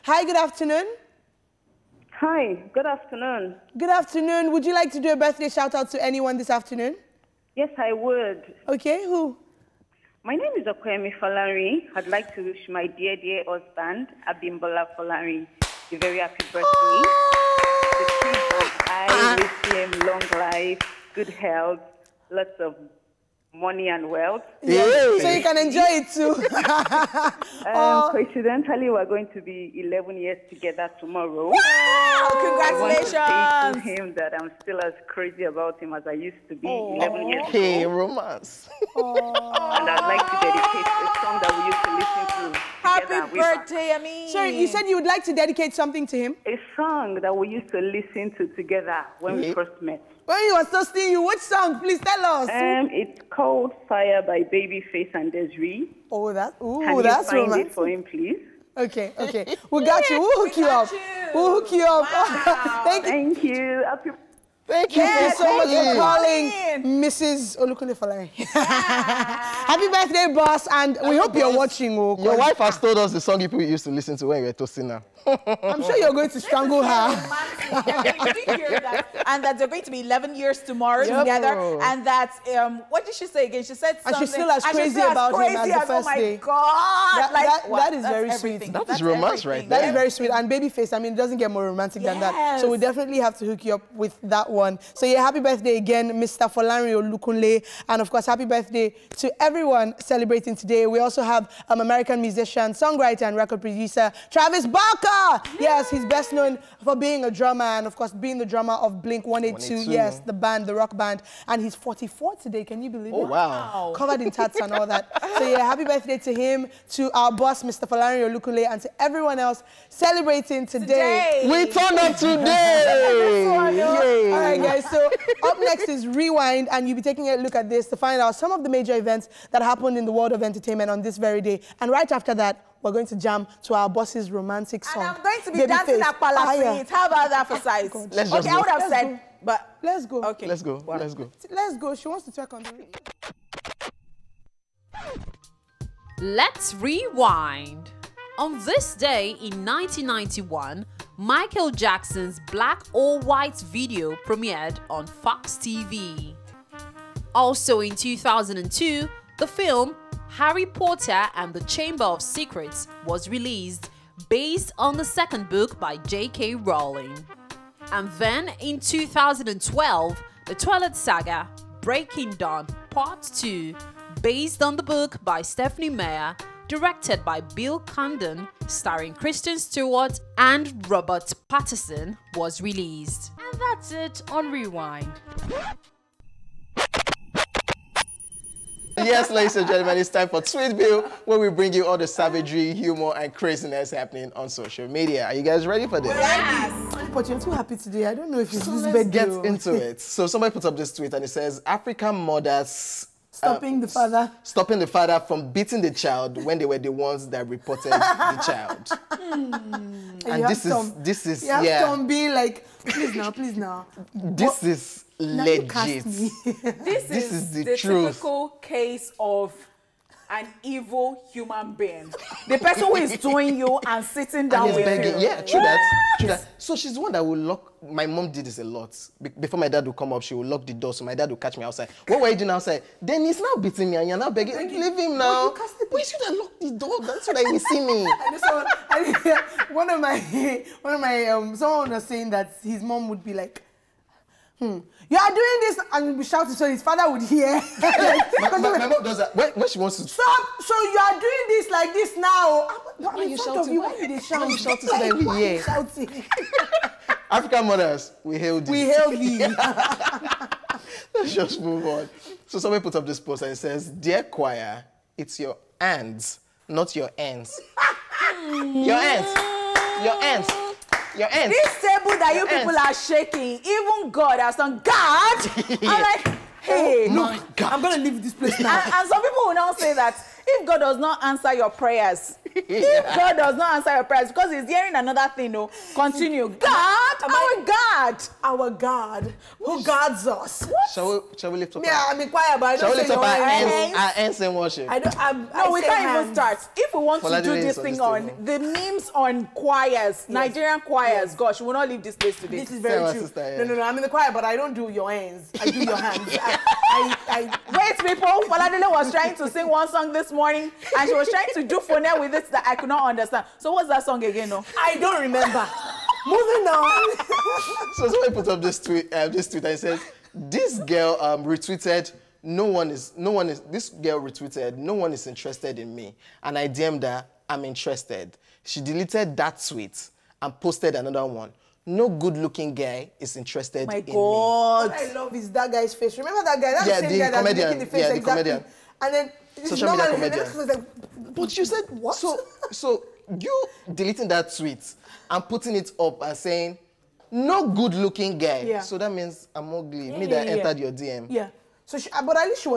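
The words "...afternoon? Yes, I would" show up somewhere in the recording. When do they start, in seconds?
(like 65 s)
6 s.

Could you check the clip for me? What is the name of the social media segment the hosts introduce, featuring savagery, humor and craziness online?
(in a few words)
Tweetville.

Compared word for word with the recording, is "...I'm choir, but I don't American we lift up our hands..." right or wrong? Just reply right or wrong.
wrong.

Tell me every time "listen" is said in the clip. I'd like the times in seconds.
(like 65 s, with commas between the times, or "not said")
42 s, 47 s, 73 s.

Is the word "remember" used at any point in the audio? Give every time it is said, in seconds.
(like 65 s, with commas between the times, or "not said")
315 s, 336 s.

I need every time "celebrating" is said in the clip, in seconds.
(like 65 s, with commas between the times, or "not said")
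99 s, 119 s.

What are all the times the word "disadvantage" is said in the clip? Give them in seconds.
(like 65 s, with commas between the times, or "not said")
not said.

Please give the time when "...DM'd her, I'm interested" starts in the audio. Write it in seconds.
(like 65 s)
326 s.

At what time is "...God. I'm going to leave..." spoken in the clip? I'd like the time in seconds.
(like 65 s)
277 s.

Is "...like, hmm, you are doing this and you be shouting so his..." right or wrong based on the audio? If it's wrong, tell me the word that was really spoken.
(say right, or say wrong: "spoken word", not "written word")
right.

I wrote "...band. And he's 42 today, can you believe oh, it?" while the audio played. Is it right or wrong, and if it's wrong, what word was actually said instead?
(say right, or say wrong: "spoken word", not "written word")
wrong: "44", not "42".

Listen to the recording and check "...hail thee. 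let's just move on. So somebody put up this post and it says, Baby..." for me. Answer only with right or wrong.
wrong.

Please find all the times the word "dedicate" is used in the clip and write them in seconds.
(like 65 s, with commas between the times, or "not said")
41 s, 45 s.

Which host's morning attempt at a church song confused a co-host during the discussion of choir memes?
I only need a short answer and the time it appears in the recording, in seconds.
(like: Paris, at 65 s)
Faladile, at 308 s.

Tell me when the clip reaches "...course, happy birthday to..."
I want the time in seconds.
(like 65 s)
98 s.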